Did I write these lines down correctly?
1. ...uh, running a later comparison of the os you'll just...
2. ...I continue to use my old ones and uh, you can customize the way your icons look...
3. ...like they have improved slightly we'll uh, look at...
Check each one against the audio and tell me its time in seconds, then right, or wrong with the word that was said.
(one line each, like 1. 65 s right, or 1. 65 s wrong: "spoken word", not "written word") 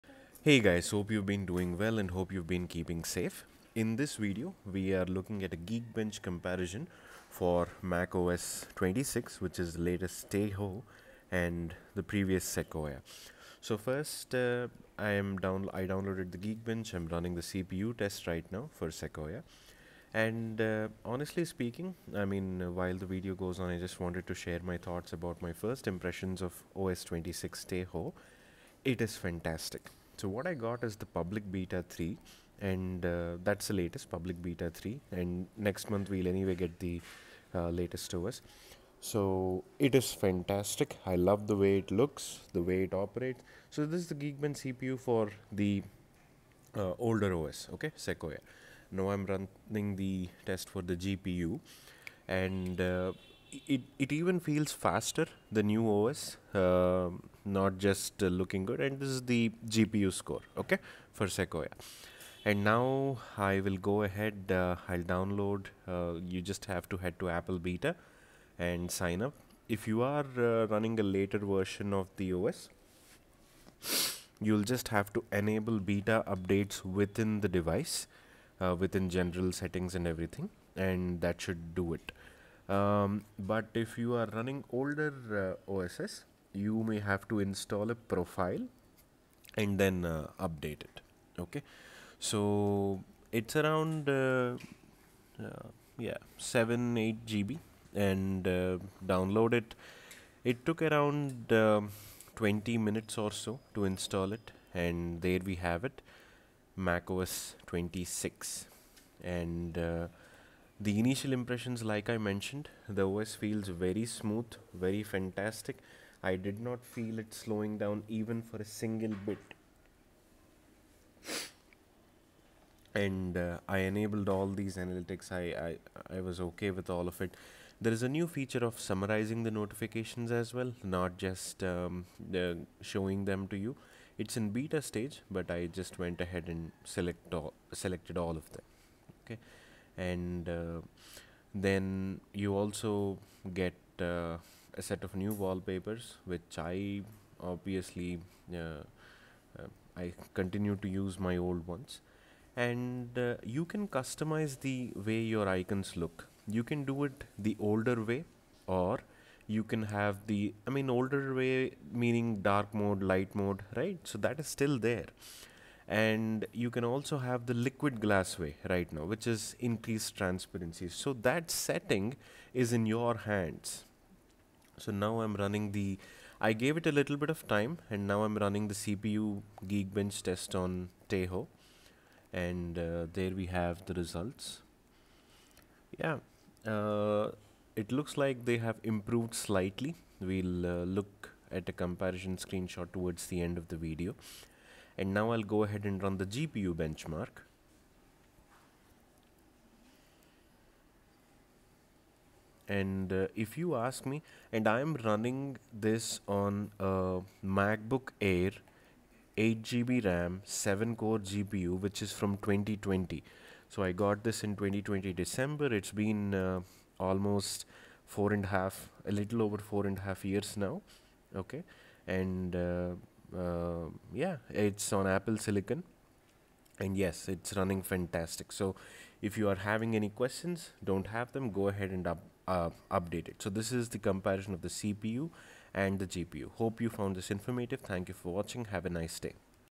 1. 70 s wrong: "version", not "comparison"
2. 149 s right
3. 188 s right.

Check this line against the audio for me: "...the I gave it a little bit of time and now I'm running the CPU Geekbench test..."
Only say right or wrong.
right.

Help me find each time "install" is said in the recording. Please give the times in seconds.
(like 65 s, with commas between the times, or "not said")
87 s, 103 s.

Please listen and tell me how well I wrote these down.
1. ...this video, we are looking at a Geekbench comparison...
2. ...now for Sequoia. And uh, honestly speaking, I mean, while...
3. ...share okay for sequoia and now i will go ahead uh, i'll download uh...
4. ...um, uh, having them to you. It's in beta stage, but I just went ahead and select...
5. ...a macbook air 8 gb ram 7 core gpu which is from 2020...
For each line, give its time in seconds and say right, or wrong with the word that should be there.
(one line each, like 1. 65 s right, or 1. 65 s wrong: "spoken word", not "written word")
1. 3 s right
2. 18 s right
3. 60 s wrong: "score", not "share"
4. 131 s wrong: "showing", not "having"
5. 206 s right.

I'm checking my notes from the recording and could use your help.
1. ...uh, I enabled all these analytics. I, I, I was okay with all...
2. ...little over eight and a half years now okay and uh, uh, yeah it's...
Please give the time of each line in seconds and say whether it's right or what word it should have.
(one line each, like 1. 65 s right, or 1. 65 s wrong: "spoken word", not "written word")
1. 123 s right
2. 219 s wrong: "four", not "eight".